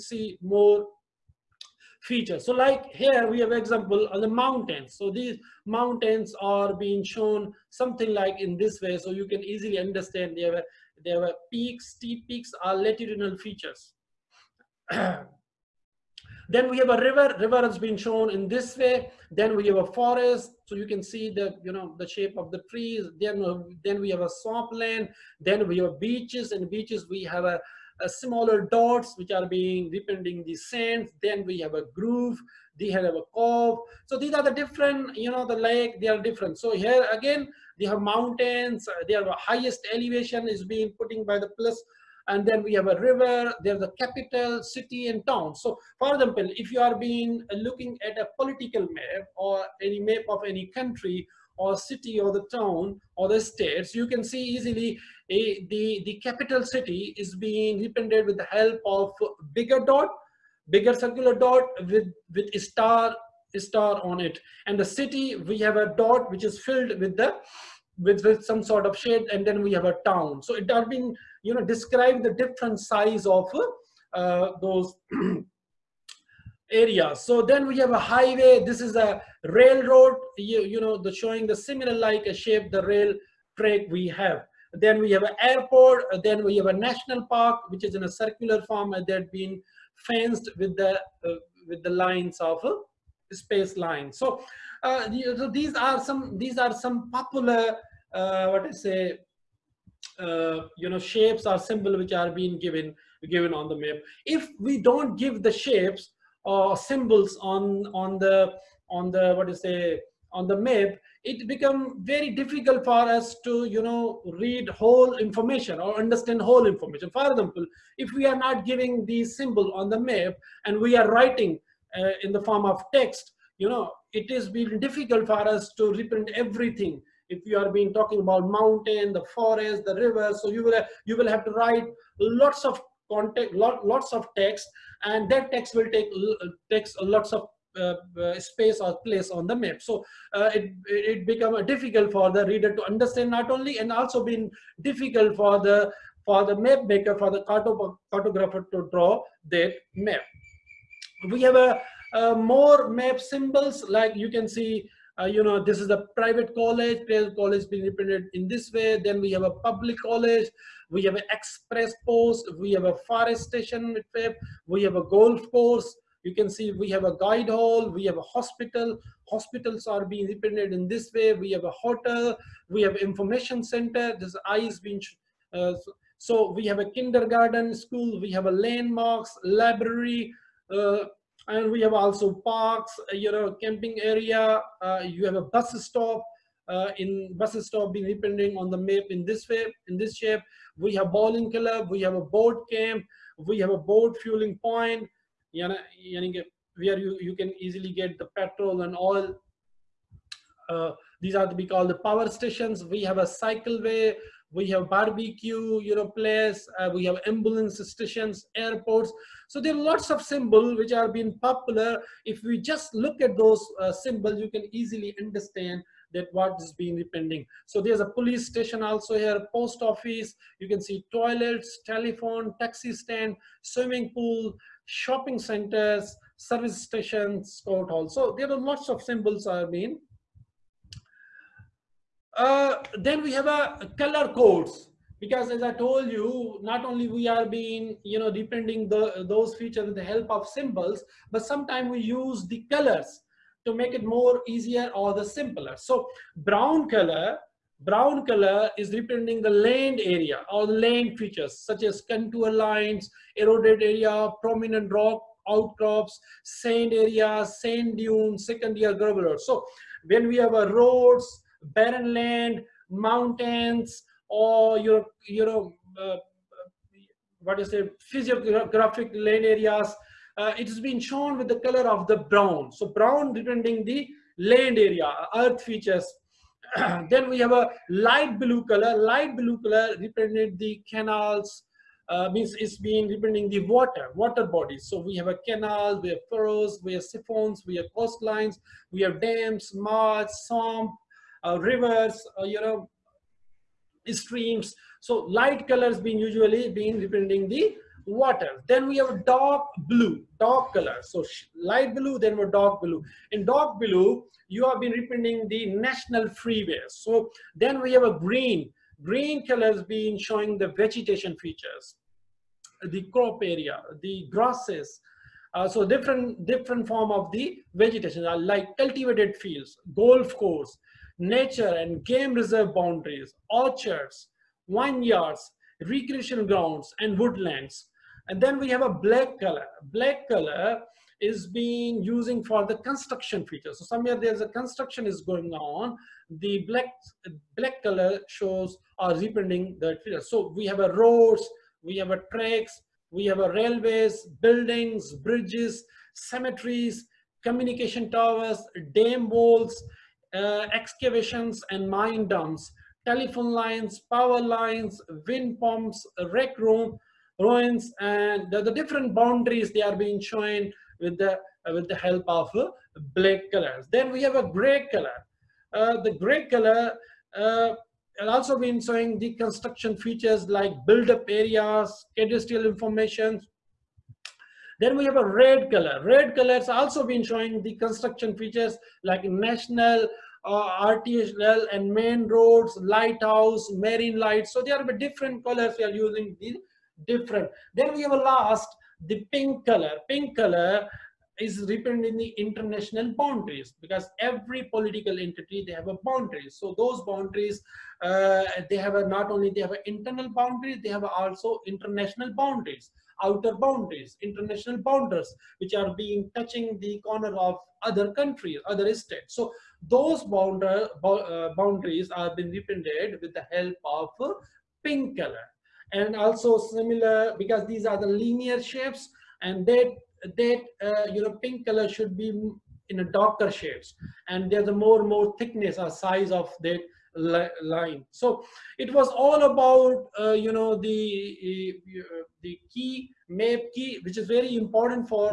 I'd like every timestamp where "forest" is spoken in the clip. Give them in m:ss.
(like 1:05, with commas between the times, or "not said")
0:19, 2:09, 2:43.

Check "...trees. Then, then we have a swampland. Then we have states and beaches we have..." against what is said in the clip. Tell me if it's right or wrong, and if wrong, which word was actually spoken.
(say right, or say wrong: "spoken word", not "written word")
wrong: "beaches", not "states".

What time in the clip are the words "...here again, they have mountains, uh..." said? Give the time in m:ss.
0:36.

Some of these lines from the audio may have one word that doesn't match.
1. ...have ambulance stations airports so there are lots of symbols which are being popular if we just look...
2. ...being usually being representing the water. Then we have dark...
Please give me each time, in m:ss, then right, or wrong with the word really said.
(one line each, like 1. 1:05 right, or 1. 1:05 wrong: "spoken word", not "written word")
1. 3:27 right
2. 4:55 right.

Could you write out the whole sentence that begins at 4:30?
Uh, it has been shown with the color of the brown.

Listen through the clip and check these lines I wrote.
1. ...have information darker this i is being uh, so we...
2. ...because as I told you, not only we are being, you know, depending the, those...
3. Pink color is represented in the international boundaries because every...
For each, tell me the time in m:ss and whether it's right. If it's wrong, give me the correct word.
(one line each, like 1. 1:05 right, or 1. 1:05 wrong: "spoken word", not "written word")
1. 2:52 wrong: "center", not "darker"
2. 3:55 right
3. 6:30 right.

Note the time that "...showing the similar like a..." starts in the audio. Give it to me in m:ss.
1:21.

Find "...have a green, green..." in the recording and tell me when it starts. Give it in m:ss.
5:07.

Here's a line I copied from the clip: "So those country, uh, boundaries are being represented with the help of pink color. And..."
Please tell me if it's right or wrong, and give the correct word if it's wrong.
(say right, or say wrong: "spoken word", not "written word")
wrong: "boundary", not "country".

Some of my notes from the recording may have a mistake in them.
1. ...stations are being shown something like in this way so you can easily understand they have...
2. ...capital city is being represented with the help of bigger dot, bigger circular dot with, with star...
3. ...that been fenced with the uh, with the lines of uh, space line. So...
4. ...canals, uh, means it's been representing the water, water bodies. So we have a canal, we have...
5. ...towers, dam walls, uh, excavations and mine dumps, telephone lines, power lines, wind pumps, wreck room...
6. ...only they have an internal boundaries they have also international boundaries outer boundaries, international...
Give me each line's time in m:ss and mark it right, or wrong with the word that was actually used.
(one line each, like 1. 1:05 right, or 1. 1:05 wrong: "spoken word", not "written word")
1. 0:05 wrong: "mountains", not "stations"
2. 0:56 right
3. 1:29 right
4. 4:40 right
5. 5:48 right
6. 6:39 right.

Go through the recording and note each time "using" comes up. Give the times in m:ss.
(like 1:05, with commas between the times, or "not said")
5:32, 6:25.